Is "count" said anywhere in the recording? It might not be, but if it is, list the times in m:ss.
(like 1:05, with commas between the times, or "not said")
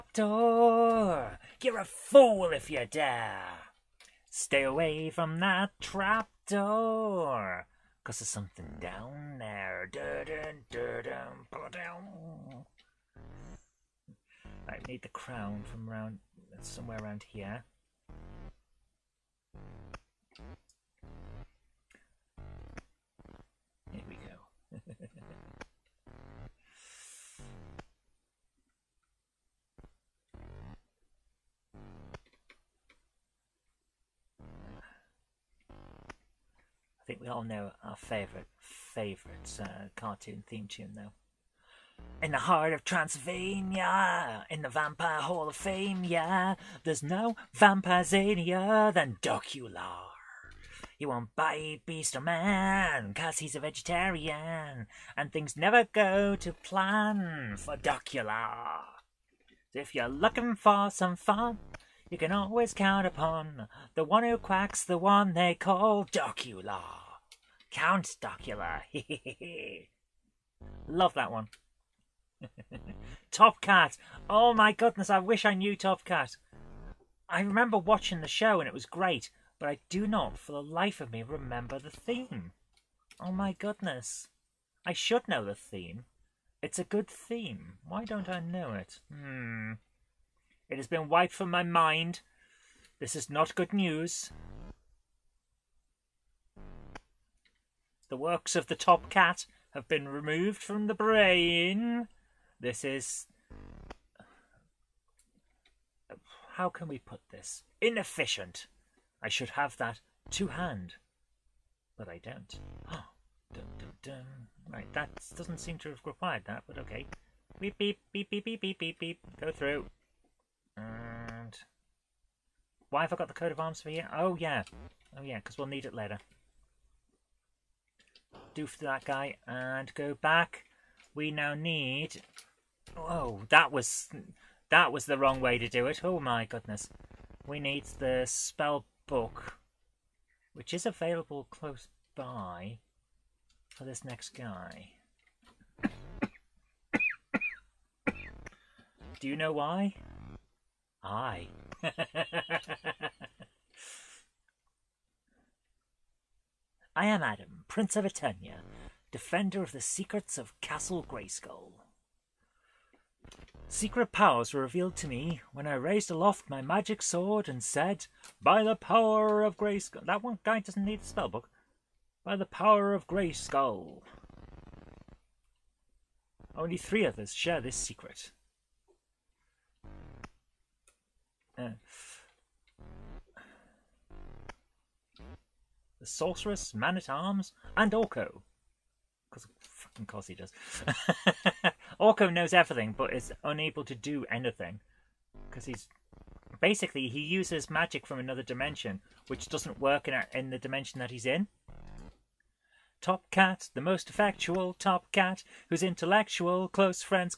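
1:02, 1:07.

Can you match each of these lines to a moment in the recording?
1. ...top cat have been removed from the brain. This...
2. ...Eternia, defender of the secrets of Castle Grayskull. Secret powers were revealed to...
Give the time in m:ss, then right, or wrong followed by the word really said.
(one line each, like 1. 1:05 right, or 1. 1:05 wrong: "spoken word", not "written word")
1. 1:38 right
2. 2:38 right.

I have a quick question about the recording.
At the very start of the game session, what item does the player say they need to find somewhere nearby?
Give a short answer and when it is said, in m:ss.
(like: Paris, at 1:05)
the crown, at 0:15.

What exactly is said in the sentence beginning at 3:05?
the sorceress, man at arms, and Orko.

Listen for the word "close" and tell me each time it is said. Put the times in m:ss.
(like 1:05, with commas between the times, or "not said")
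2:21, 3:26.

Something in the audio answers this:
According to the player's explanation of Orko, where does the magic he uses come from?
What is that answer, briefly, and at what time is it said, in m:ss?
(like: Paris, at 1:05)
another dimension, at 3:18.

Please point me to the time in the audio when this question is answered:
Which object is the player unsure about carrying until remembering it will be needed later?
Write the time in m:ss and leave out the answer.
2:03.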